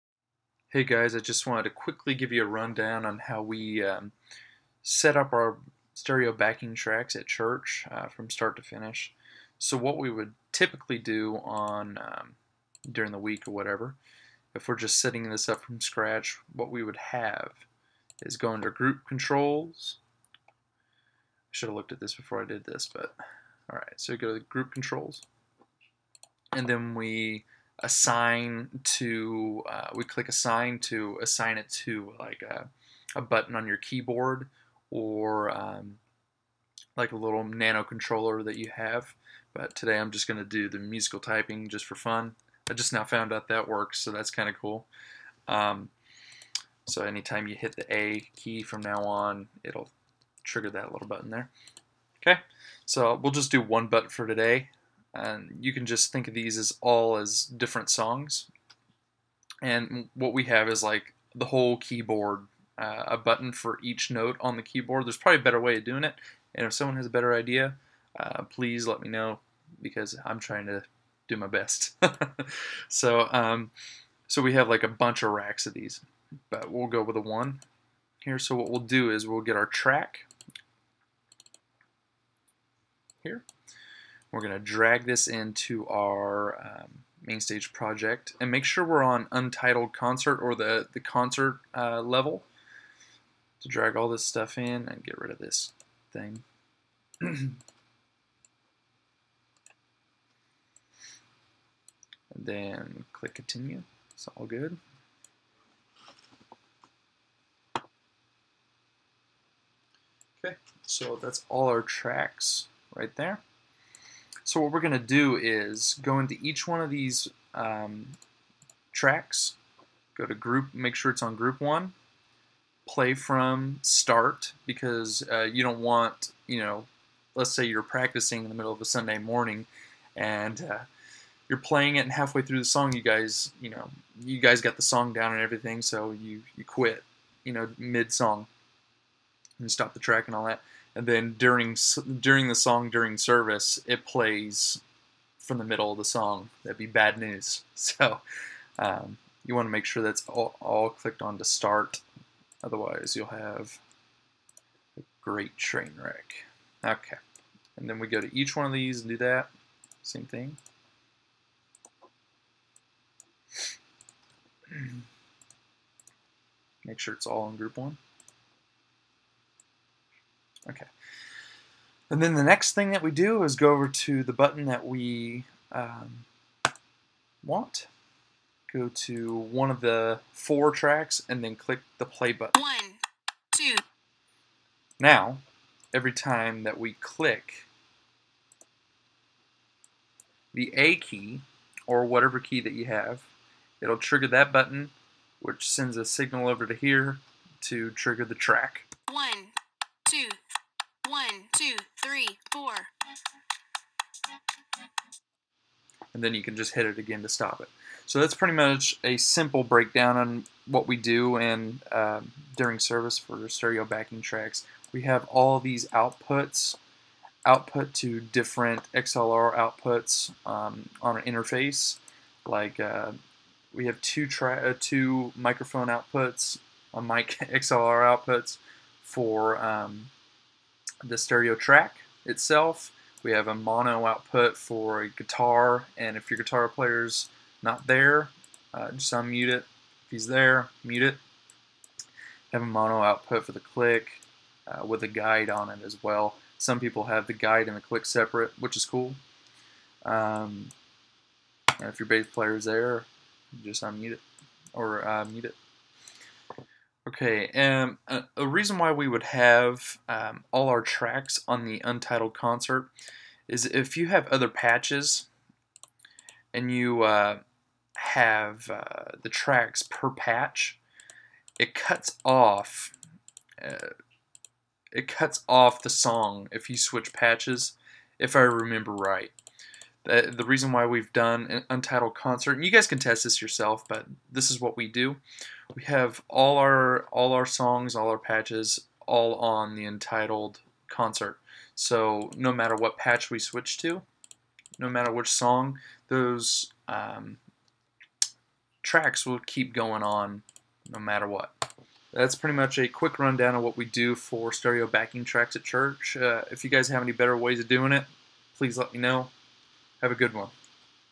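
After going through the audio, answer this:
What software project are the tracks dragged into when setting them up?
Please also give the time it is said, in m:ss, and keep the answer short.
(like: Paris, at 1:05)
MainStage, at 1:27.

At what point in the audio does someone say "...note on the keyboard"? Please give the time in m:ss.
1:04.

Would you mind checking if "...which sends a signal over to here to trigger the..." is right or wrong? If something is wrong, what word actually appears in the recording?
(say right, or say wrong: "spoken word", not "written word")
right.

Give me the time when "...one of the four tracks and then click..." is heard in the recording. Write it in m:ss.
2:59.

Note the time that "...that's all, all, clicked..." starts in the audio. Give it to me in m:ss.
2:30.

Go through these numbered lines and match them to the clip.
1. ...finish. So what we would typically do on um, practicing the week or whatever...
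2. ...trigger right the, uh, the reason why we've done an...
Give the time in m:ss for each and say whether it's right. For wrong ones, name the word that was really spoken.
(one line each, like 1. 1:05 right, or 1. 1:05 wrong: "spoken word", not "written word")
1. 0:08 wrong: "during", not "practicing"
2. 4:38 wrong: "remember", not "trigger".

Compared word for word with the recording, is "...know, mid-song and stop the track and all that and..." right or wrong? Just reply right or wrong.
right.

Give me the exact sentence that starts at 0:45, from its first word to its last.
Um, so anytime you hit the A key from now on, it'll trigger that little button there.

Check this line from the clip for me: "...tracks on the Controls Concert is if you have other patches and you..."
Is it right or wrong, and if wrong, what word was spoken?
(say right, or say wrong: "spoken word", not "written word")
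wrong: "Untitled", not "Controls".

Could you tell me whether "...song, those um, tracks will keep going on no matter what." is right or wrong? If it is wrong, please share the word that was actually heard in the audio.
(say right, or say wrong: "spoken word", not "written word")
right.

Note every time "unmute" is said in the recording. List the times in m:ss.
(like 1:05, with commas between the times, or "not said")
3:59, 4:13.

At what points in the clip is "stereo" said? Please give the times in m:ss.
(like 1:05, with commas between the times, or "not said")
0:05, 3:33, 3:51, 5:04.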